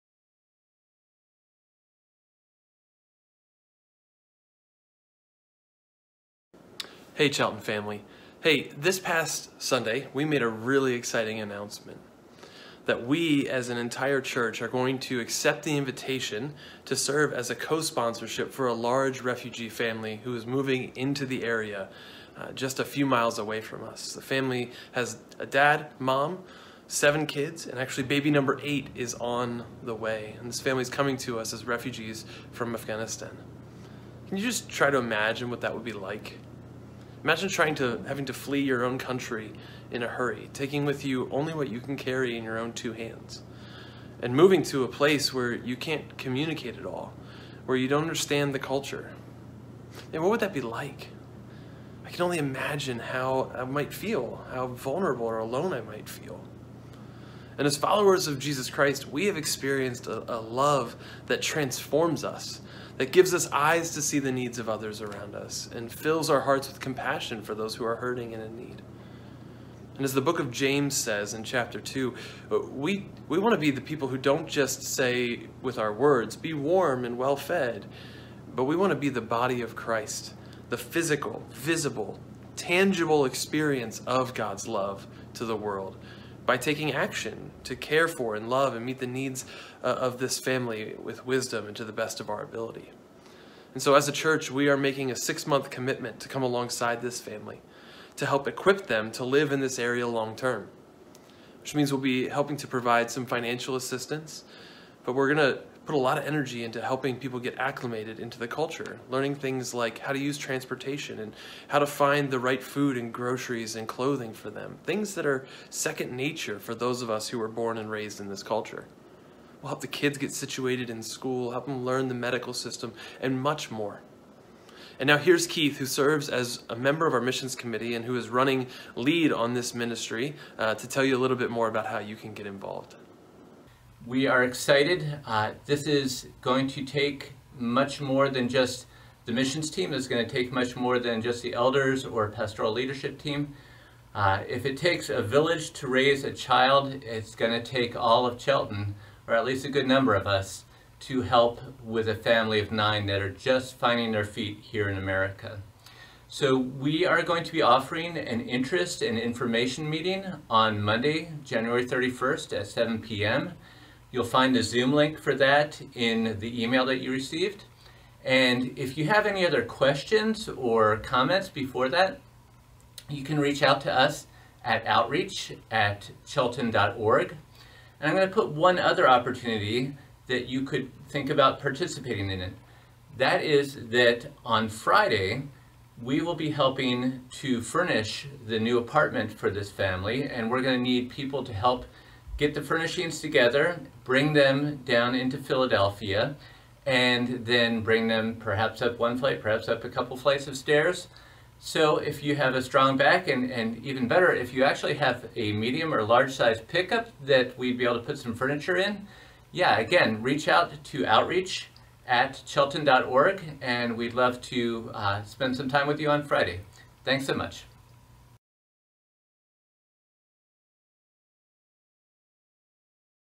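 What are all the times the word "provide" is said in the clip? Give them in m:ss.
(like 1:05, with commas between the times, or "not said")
1:42.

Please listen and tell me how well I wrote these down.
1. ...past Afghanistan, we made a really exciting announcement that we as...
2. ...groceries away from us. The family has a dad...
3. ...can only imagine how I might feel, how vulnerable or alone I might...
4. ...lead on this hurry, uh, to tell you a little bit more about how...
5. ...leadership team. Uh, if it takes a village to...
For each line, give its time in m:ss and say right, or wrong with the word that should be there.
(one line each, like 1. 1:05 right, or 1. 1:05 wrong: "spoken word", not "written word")
1. 0:08 wrong: "Sunday", not "Afghanistan"
2. 0:23 wrong: "miles", not "groceries"
3. 0:52 right
4. 2:08 wrong: "ministry", not "hurry"
5. 2:22 right.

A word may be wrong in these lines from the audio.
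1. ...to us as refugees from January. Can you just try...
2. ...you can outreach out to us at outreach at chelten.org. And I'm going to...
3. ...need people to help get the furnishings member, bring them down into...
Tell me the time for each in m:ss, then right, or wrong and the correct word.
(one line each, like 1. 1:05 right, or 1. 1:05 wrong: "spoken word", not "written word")
1. 0:31 wrong: "Afghanistan", not "January"
2. 2:53 wrong: "reach", not "outreach"
3. 3:10 wrong: "together", not "member".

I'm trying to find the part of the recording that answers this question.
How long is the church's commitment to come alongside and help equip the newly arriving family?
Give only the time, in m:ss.
1:35.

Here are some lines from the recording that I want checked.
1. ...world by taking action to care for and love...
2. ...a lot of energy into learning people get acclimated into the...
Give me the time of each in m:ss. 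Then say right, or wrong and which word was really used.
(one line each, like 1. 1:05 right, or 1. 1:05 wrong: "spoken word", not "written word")
1. 1:25 right
2. 1:45 wrong: "helping", not "learning".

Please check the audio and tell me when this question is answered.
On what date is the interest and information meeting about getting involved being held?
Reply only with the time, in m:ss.
2:40.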